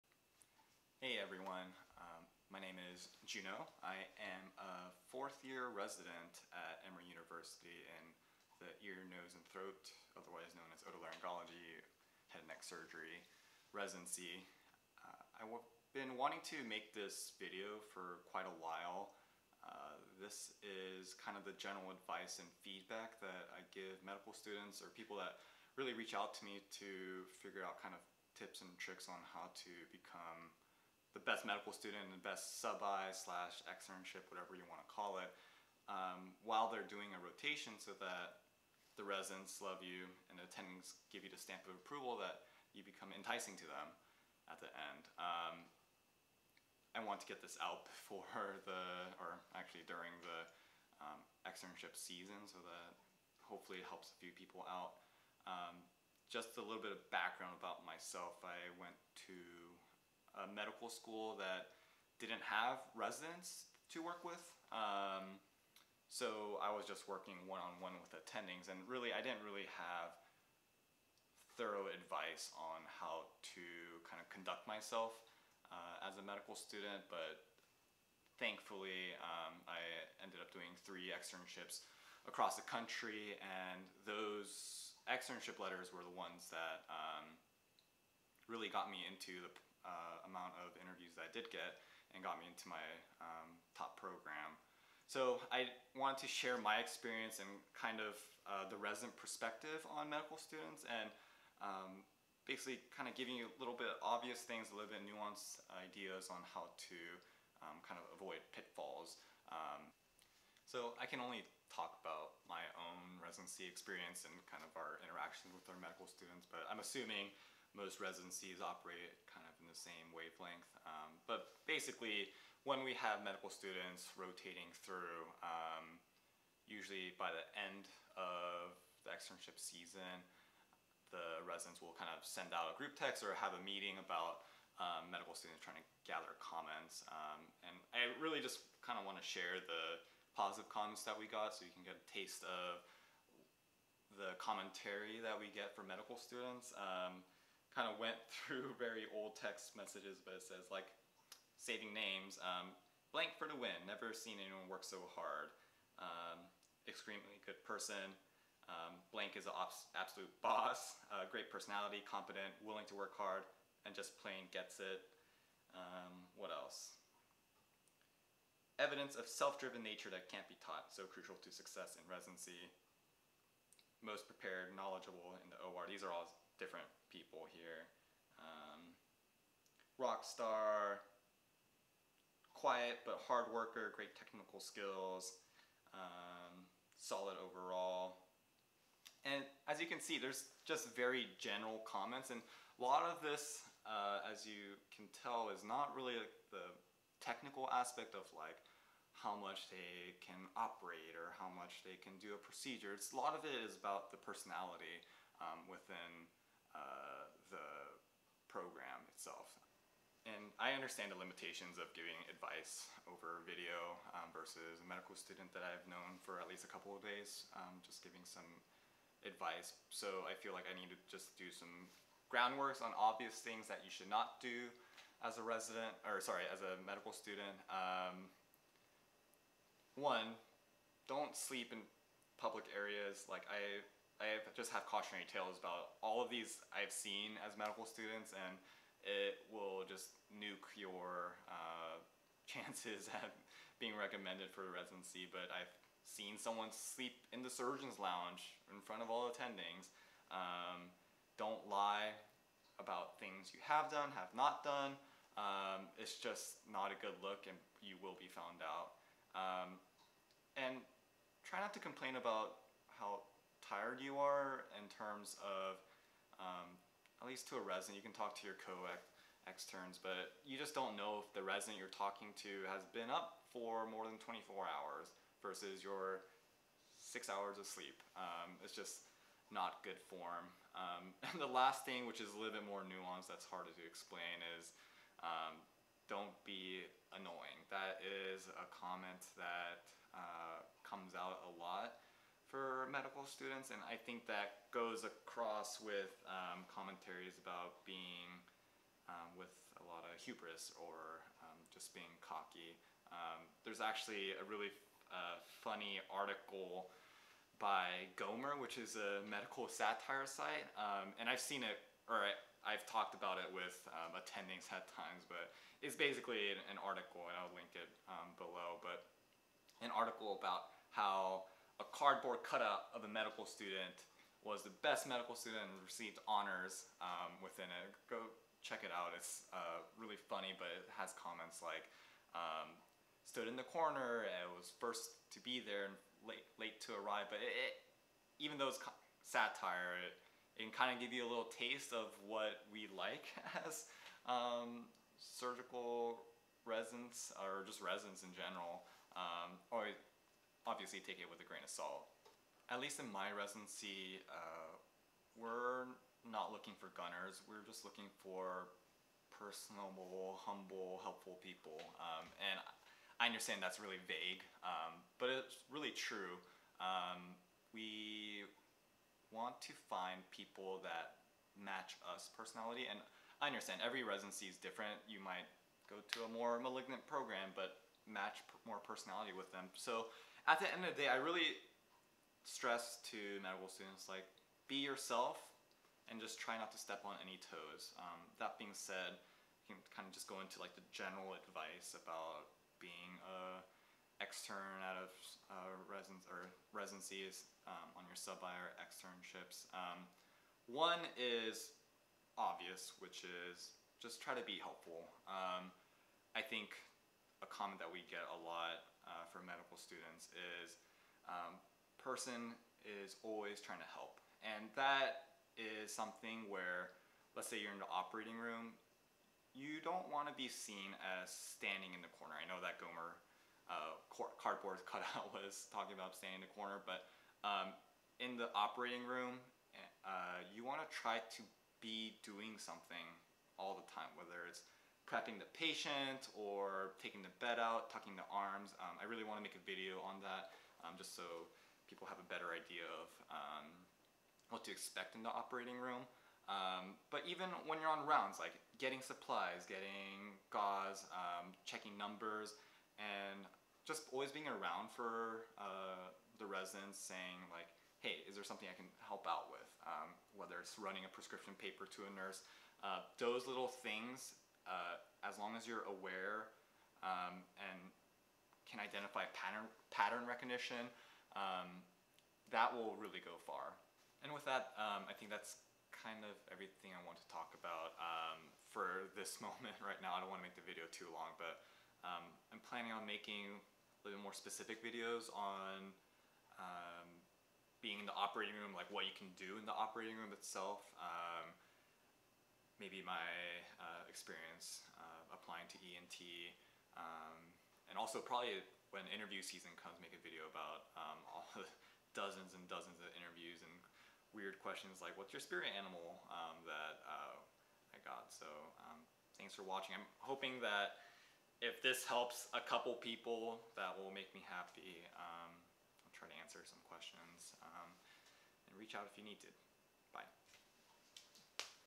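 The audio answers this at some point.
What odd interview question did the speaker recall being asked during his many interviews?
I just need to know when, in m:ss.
8:25.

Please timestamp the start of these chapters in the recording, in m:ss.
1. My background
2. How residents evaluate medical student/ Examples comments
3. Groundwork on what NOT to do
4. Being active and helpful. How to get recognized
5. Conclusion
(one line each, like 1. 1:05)
1. 0:56
2. 1:50
3. 3:30
4. 5:50
5. 7:54.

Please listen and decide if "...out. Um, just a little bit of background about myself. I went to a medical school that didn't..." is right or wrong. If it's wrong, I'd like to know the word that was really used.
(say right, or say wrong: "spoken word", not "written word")
right.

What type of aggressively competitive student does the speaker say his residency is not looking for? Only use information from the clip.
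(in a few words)
gunners.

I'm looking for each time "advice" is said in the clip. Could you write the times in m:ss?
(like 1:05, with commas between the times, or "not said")
0:21, 1:11, 3:32, 3:39, 6:31.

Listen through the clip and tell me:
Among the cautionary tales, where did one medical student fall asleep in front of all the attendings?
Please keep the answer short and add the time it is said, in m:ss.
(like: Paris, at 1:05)
surgeon's lounge, at 4:07.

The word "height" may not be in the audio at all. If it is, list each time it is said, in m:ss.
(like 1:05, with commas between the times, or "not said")
not said.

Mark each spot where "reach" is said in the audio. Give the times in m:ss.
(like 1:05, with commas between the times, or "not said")
0:25, 8:38.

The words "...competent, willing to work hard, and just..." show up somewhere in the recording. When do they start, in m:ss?
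2:42.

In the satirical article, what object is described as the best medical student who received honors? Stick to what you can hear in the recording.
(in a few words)
cardboard cutout.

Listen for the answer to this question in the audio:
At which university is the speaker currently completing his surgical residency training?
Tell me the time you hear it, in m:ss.
0:06.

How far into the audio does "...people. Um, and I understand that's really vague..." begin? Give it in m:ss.
6:01.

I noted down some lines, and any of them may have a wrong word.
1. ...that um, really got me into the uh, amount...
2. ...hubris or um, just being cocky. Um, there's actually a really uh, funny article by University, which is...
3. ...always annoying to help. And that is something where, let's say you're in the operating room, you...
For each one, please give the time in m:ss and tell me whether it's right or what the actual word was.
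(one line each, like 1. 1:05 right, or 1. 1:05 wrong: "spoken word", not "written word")
1. 1:26 right
2. 5:00 wrong: "Gomer", not "University"
3. 6:53 wrong: "trying", not "annoying".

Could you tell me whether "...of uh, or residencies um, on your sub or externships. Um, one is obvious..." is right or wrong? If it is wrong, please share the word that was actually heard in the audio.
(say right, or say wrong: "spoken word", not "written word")
right.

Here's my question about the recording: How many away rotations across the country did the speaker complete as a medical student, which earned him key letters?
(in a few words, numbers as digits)
3.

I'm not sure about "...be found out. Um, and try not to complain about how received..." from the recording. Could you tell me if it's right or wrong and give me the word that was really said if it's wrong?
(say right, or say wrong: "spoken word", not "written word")
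wrong: "tired", not "received".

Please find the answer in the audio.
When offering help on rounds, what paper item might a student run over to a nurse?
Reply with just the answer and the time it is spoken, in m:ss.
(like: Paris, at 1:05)
prescription paper, at 7:41.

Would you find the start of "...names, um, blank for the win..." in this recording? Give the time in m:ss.
2:31.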